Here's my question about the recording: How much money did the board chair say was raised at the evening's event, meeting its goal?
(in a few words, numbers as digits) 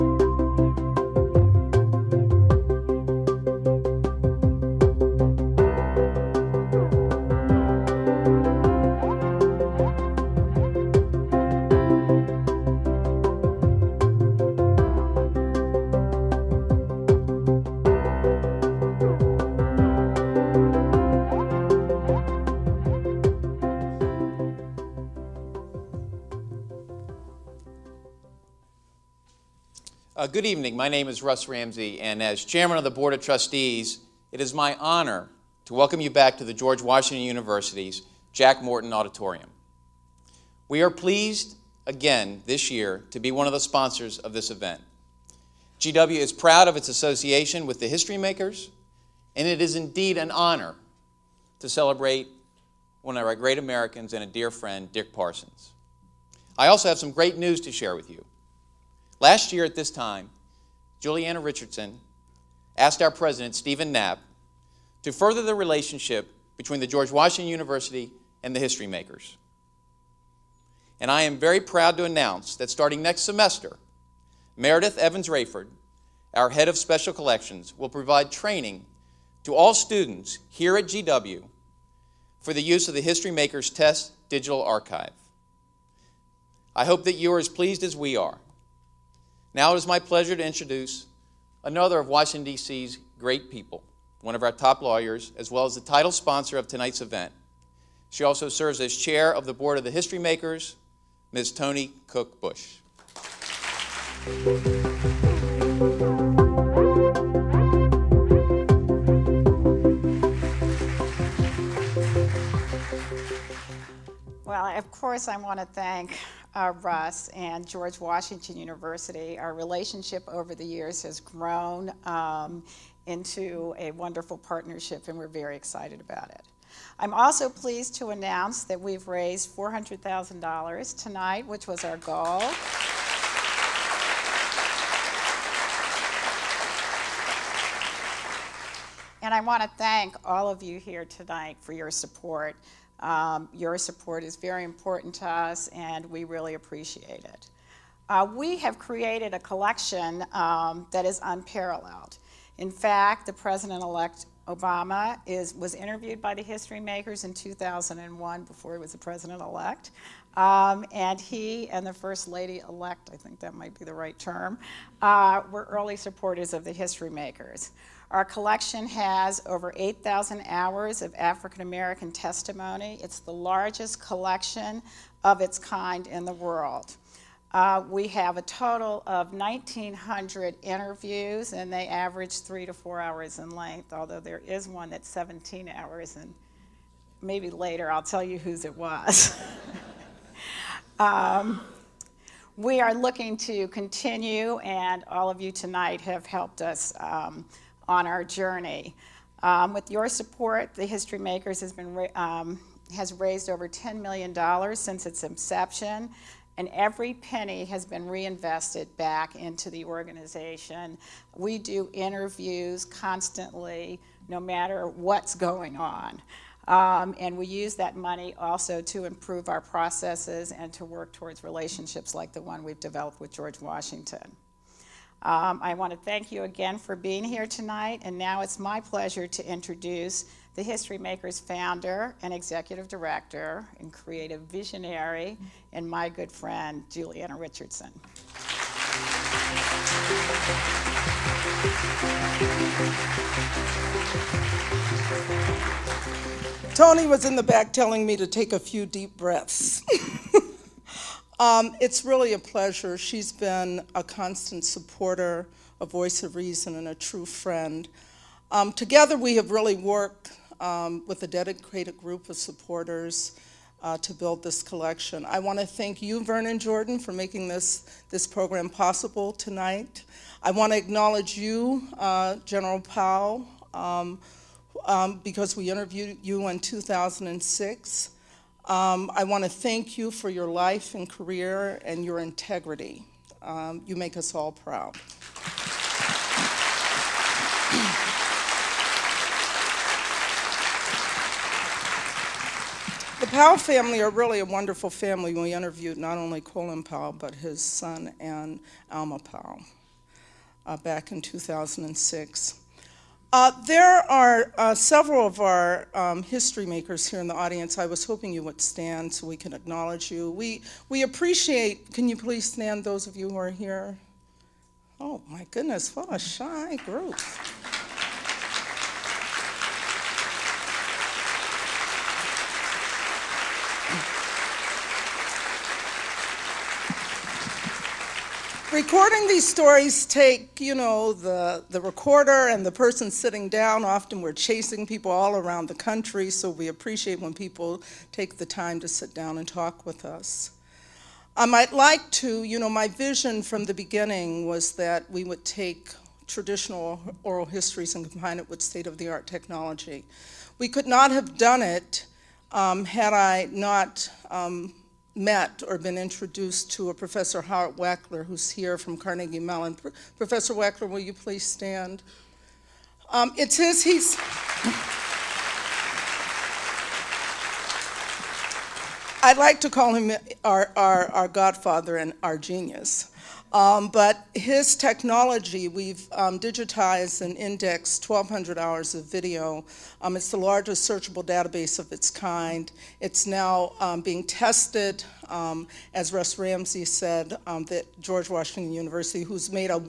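$400,000.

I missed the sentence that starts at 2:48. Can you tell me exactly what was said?
Our collection has over 8,000 hours of African American testimony.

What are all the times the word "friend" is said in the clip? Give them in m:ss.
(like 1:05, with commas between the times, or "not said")
0:54, 3:56, 4:17.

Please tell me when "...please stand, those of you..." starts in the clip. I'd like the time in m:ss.
5:12.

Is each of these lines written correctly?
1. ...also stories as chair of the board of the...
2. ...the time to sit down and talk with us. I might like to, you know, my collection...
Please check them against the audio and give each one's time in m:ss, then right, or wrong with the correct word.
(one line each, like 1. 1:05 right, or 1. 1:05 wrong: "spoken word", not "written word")
1. 1:38 wrong: "serves", not "stories"
2. 5:38 wrong: "vision", not "collection".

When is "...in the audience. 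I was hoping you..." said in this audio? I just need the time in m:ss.
5:07.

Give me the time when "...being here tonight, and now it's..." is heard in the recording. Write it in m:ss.
3:46.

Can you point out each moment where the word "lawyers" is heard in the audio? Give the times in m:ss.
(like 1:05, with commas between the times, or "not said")
1:34.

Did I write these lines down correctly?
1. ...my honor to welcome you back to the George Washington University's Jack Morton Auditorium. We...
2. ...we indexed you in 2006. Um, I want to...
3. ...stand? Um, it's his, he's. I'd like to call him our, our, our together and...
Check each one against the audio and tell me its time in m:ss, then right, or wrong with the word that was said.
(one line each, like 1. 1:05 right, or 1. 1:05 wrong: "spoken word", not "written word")
1. 0:34 right
2. 4:35 wrong: "interviewed", not "indexed"
3. 6:01 wrong: "godfather", not "together".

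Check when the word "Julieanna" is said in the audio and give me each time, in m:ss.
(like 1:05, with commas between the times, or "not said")
1:01, 3:56.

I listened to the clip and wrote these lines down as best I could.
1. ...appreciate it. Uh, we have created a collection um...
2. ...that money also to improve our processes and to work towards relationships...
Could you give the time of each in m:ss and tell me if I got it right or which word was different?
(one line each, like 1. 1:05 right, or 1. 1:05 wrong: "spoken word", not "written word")
1. 2:26 right
2. 3:37 right.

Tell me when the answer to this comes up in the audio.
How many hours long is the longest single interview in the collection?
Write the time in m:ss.
3:05.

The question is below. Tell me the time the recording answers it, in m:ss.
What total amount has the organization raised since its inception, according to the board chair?
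3:23.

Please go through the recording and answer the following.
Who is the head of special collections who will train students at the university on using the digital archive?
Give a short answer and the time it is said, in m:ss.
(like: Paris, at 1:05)
Meredith Evans Raiford, at 1:14.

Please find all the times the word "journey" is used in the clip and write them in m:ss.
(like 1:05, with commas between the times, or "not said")
3:18.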